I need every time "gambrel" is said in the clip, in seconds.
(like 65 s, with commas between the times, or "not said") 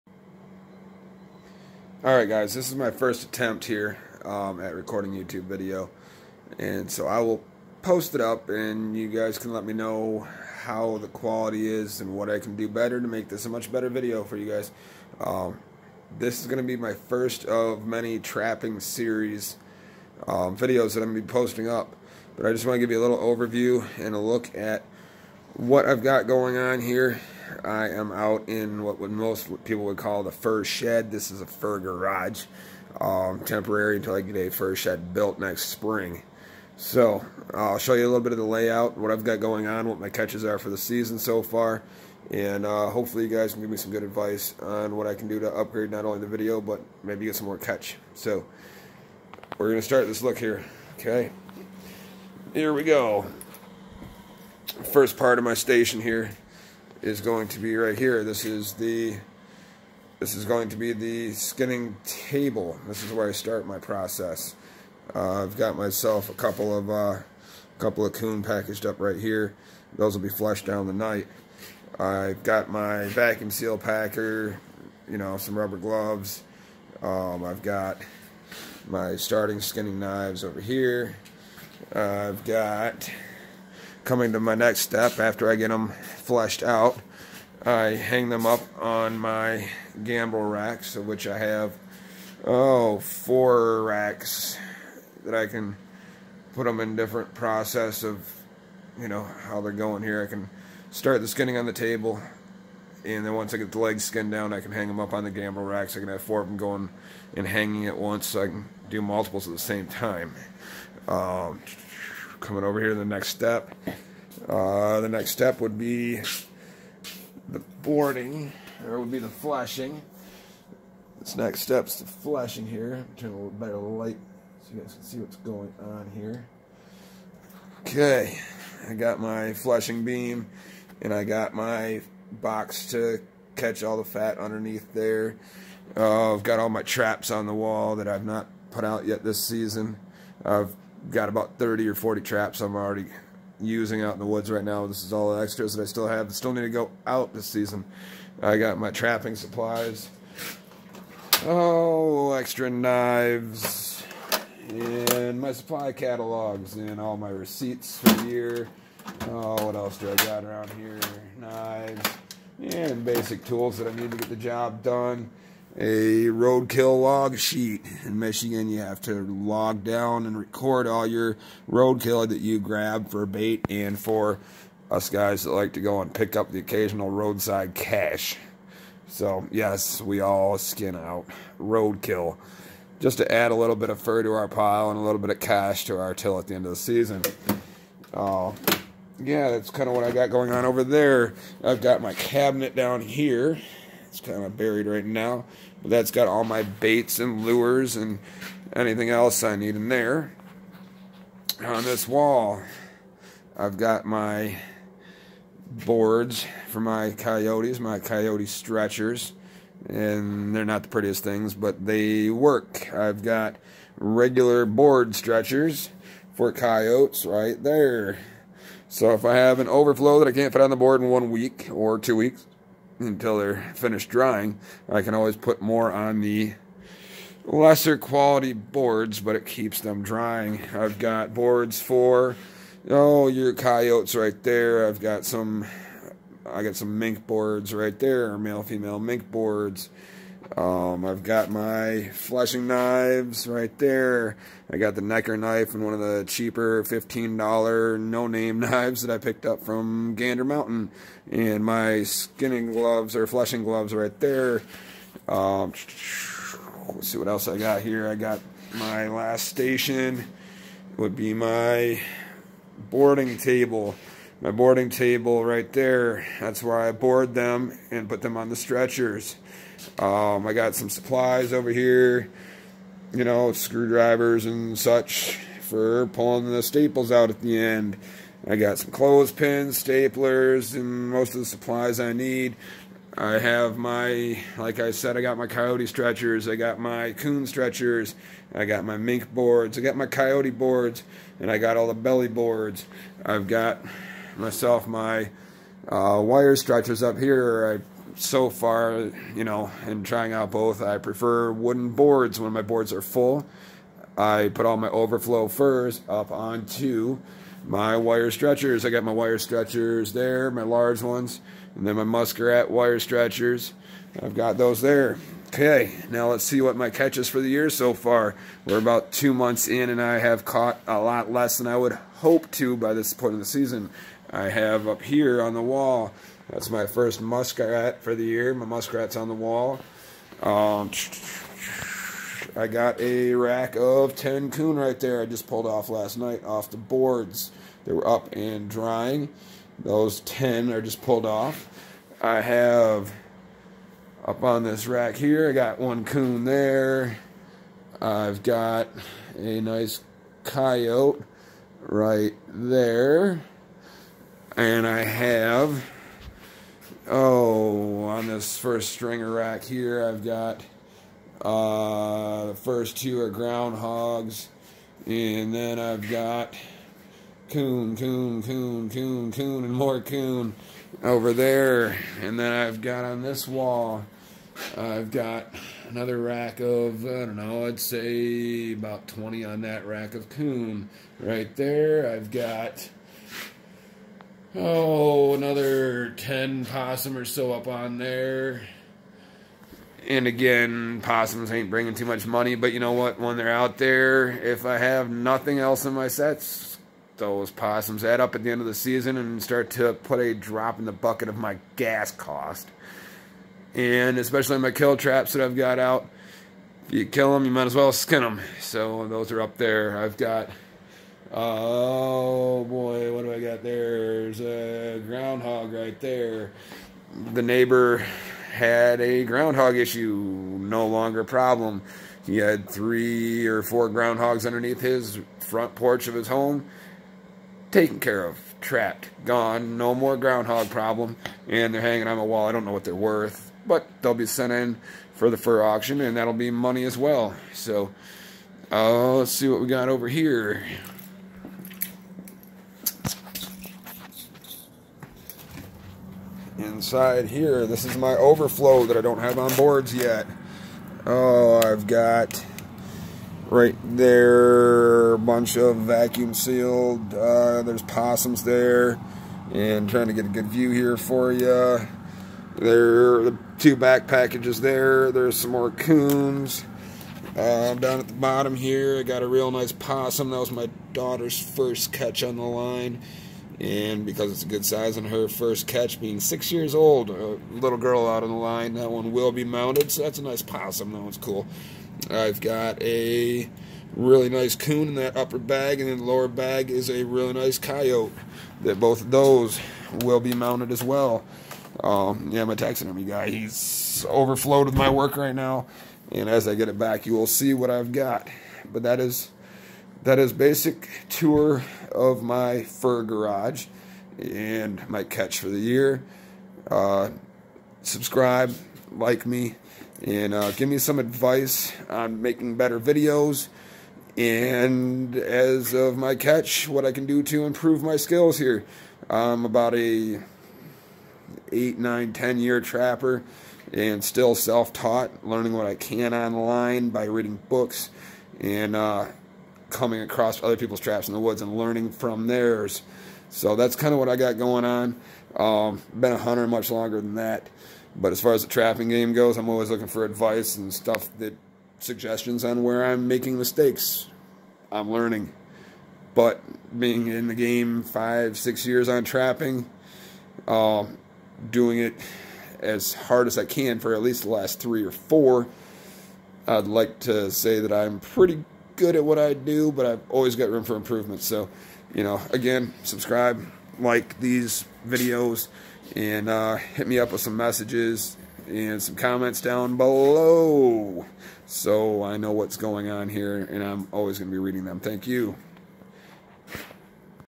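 90 s, 105 s.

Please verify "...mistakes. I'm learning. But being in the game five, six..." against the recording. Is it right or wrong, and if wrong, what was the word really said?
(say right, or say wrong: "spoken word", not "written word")
right.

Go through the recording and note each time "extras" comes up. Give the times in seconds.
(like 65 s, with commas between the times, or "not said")
145 s, 152 s.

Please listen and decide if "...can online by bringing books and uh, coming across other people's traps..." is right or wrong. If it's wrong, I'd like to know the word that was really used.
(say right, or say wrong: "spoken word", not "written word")
wrong: "reading", not "bringing".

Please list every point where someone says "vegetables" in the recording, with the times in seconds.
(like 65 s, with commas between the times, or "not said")
not said.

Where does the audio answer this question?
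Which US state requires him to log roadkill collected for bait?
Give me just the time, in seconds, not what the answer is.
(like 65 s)
168 s.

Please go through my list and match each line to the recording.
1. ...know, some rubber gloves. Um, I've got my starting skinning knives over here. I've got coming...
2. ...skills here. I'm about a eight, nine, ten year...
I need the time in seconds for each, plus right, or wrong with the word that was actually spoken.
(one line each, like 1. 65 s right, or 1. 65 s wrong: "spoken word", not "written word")
1. 75 s right
2. 517 s right.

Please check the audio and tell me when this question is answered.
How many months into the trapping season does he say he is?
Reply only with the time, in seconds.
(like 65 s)
319 s.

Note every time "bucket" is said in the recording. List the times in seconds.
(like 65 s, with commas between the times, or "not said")
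400 s.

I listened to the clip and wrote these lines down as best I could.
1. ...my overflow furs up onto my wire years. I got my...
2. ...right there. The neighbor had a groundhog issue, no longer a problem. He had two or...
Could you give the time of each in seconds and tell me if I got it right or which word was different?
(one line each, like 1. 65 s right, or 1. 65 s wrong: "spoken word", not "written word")
1. 304 s wrong: "stretchers", not "years"
2. 415 s wrong: "three", not "two".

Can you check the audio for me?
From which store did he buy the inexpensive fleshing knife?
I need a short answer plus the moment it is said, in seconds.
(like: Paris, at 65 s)
Gander Mountain, at 250 s.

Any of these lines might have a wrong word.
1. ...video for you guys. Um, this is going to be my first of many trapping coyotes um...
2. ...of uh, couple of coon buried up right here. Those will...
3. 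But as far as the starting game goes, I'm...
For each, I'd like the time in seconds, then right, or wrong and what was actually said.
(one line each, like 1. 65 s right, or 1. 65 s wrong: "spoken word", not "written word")
1. 13 s wrong: "series", not "coyotes"
2. 66 s wrong: "packaged", not "buried"
3. 537 s wrong: "trapping", not "starting".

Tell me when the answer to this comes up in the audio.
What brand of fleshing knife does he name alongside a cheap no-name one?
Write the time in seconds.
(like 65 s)
245 s.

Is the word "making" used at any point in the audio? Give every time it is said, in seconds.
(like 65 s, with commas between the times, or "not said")
512 s, 543 s.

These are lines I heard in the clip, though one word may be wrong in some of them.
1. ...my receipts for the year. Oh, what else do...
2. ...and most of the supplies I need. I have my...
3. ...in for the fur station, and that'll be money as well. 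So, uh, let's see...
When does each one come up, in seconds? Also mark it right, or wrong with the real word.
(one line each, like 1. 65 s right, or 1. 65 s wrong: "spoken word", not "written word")
1. 157 s right
2. 280 s right
3. 434 s wrong: "auction", not "station".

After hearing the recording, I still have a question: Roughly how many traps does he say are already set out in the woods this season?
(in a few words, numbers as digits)
30 or 40.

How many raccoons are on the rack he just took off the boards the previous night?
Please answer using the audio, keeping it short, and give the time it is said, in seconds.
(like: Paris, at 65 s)
10, at 334 s.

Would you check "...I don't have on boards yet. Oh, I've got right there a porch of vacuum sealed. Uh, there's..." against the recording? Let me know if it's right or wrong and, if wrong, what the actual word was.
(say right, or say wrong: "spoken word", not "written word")
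wrong: "bunch", not "porch".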